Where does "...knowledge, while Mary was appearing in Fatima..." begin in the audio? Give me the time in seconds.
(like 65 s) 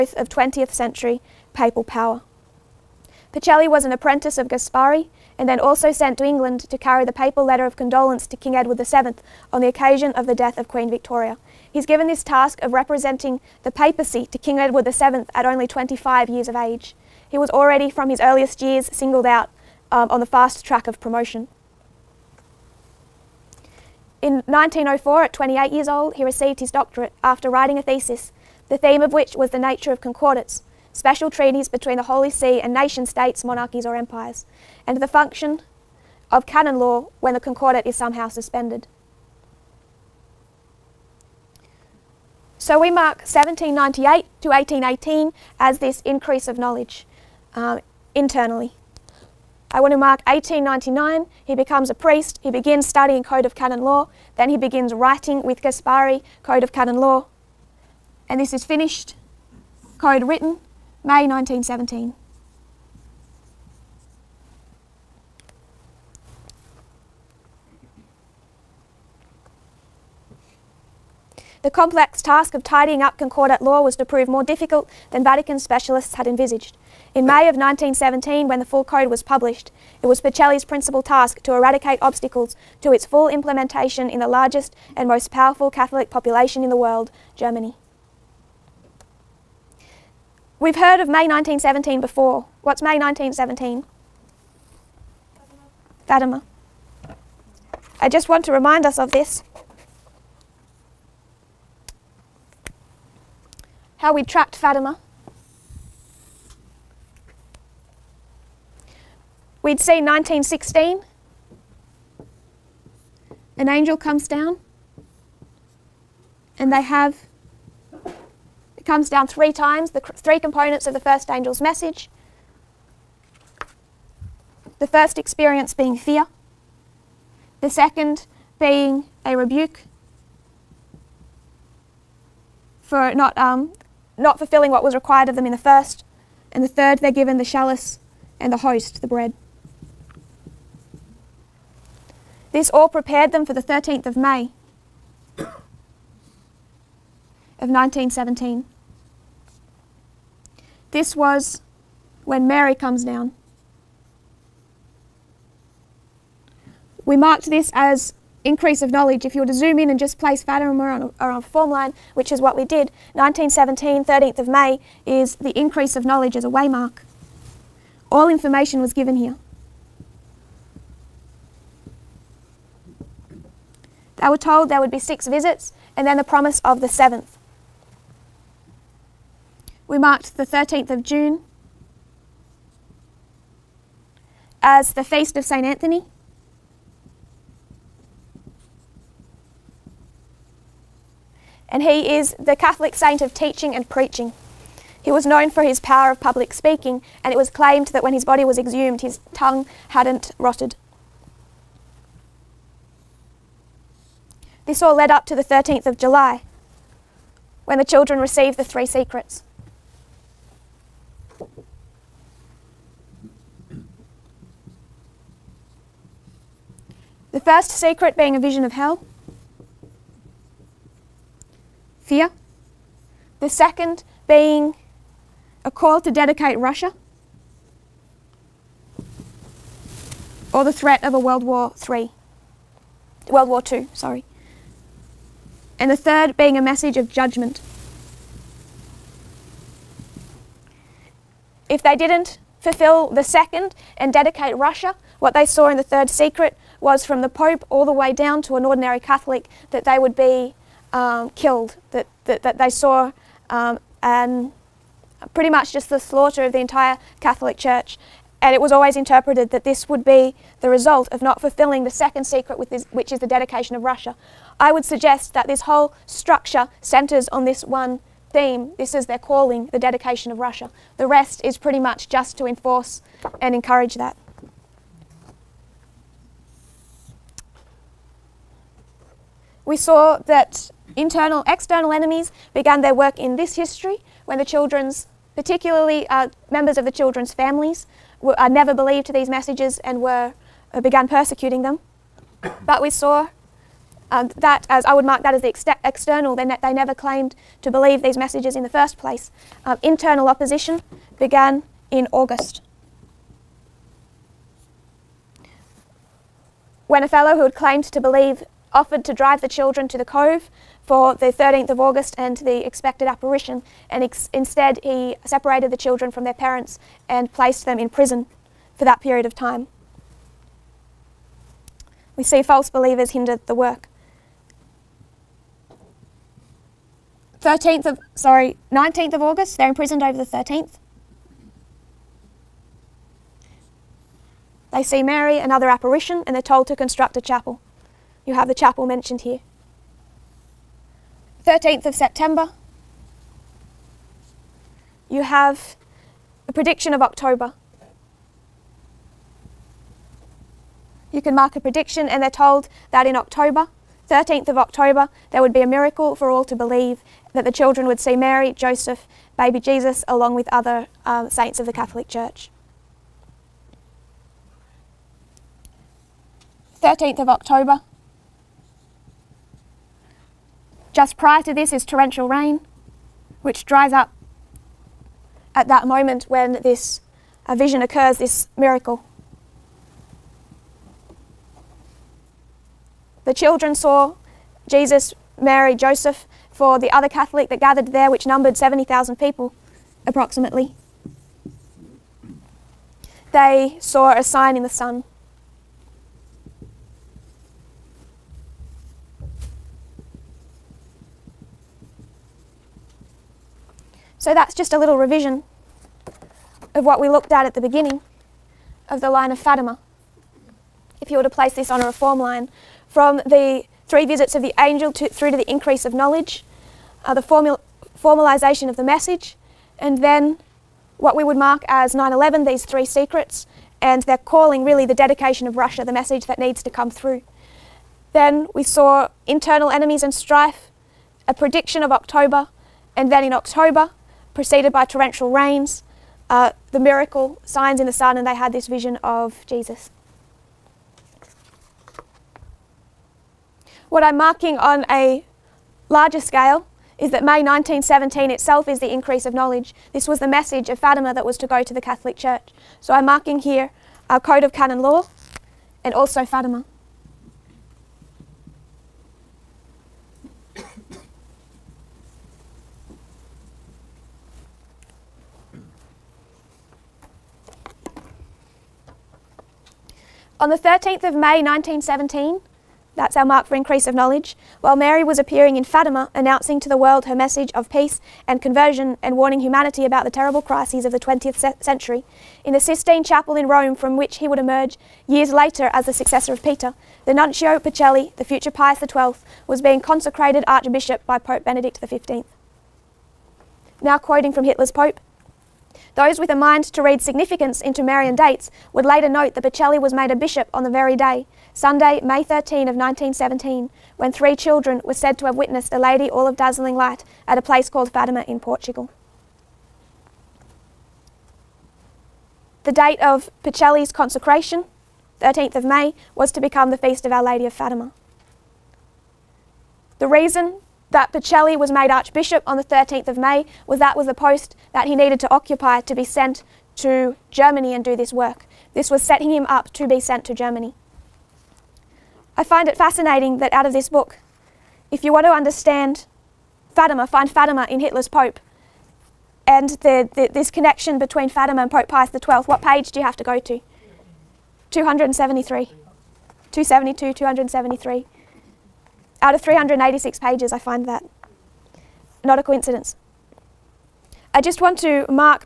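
473 s.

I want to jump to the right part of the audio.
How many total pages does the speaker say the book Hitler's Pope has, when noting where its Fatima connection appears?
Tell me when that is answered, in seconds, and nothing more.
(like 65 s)
549 s.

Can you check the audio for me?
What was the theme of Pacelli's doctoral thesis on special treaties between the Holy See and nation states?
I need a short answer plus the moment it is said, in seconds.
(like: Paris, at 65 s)
the nature of concordance, at 29 s.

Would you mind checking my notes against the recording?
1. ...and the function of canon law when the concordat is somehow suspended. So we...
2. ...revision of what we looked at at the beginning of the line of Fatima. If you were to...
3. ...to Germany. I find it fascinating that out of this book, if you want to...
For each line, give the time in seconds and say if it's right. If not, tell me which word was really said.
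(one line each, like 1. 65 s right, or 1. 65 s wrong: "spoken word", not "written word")
1. 34 s right
2. 404 s right
3. 530 s right.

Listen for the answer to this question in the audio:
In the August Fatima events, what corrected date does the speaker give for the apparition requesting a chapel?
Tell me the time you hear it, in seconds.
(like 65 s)
328 s.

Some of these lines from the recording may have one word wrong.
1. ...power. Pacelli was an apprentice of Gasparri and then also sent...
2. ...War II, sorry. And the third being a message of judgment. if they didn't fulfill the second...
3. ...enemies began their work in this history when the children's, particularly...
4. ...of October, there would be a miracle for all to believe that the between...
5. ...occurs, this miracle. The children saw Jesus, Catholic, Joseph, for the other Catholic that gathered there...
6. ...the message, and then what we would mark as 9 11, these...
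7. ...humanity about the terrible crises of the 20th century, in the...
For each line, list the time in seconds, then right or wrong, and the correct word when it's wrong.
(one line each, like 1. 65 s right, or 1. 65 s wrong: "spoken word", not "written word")
1. 1 s right
2. 233 s right
3. 281 s right
4. 354 s wrong: "children", not "between"
5. 377 s wrong: "Mary", not "Catholic"
6. 418 s right
7. 479 s right.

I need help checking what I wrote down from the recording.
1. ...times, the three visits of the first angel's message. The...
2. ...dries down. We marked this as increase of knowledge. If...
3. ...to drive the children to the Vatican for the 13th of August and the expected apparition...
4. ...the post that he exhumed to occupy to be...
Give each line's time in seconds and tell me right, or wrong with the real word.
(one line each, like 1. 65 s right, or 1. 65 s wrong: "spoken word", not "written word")
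1. 119 s wrong: "components", not "visits"
2. 152 s wrong: "comes", not "dries"
3. 309 s wrong: "Cove", not "Vatican"
4. 524 s wrong: "needed", not "exhumed".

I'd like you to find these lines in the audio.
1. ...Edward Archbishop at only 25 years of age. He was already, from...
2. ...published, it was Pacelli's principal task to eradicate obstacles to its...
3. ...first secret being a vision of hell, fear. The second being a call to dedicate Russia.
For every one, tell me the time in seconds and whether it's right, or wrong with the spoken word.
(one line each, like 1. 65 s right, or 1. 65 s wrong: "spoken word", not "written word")
1. 14 s wrong: "VII", not "Archbishop"
2. 79 s right
3. 217 s right.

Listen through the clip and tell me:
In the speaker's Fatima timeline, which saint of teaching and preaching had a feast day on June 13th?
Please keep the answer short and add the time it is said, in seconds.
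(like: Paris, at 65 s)
St. Anthony, at 185 s.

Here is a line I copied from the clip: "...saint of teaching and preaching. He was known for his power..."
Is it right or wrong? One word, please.
right.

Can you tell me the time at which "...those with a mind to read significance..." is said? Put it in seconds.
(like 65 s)
495 s.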